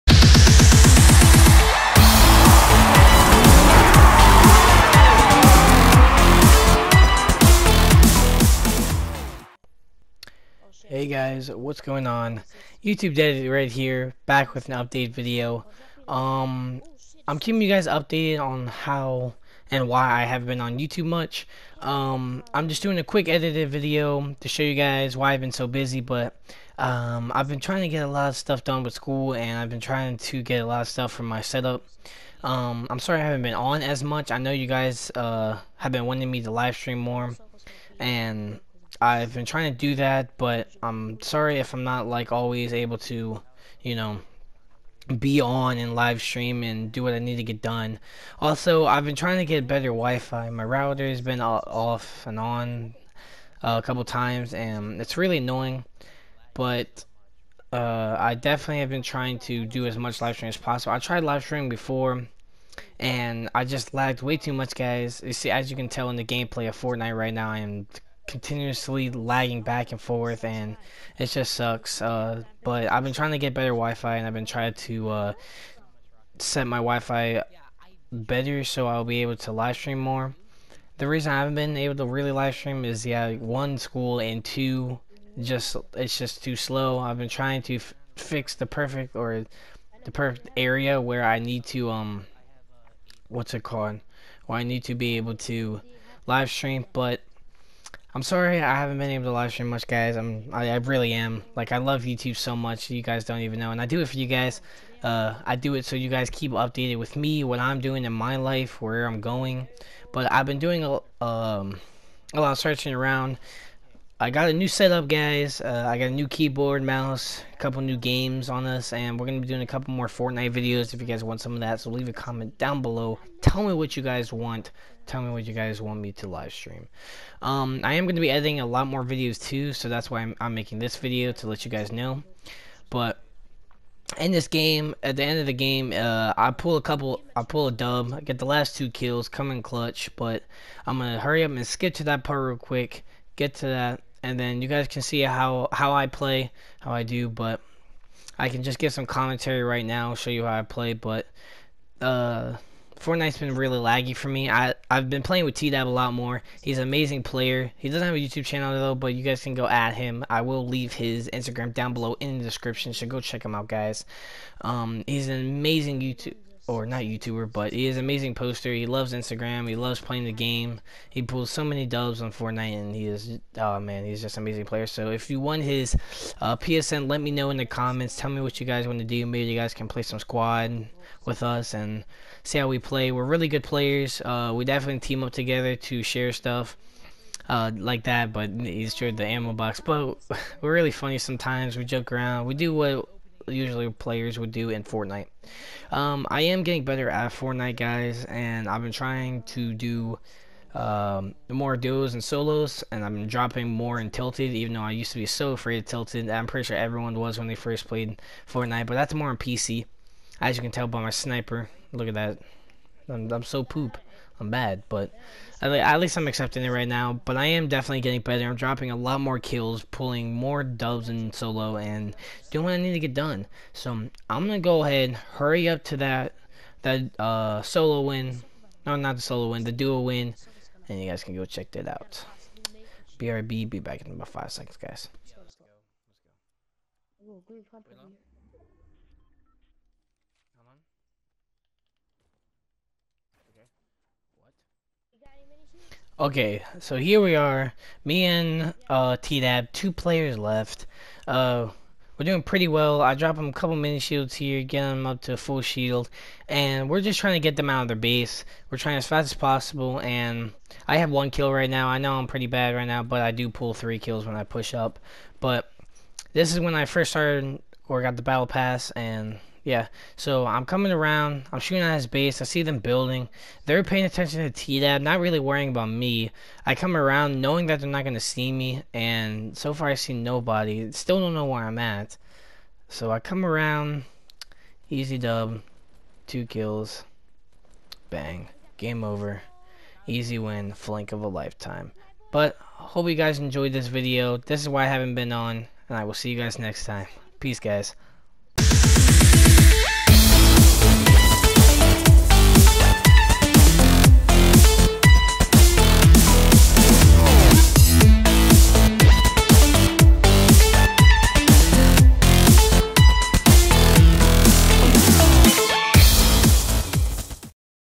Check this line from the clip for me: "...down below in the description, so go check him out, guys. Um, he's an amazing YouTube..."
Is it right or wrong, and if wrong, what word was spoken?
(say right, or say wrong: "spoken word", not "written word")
right.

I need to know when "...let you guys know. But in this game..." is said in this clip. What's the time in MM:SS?
02:11.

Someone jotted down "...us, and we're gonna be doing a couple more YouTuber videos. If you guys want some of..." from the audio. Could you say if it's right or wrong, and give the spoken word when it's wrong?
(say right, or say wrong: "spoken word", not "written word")
wrong: "Fortnite", not "YouTuber".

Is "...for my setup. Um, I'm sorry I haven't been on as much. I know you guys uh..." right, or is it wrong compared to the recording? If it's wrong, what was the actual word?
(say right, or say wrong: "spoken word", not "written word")
right.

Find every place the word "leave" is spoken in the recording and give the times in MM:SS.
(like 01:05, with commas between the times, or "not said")
02:01, 02:40.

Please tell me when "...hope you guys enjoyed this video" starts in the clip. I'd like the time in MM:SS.
04:52.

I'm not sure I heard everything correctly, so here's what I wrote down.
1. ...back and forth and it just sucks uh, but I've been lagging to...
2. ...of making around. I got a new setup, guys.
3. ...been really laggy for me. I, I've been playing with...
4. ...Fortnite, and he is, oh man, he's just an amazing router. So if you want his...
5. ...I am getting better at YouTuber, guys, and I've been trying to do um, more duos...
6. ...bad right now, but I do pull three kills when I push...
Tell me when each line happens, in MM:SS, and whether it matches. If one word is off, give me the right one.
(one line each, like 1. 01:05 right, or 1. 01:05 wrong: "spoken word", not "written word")
1. 01:09 wrong: "trying", not "lagging"
2. 01:52 wrong: "searching", not "making"
3. 02:33 right
4. 02:52 wrong: "player", not "router"
5. 03:16 wrong: "Fortnite", not "YouTuber"
6. 04:22 right.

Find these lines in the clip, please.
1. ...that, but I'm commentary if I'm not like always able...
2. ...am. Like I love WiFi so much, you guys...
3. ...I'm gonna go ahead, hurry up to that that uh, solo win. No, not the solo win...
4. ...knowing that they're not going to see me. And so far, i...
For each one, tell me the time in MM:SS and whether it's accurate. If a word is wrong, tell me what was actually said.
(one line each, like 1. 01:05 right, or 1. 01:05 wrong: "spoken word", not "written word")
1. 00:39 wrong: "sorry", not "commentary"
2. 01:41 wrong: "YouTube", not "WiFi"
3. 03:43 right
4. 04:37 right.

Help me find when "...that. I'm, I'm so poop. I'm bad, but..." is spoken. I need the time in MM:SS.
03:32.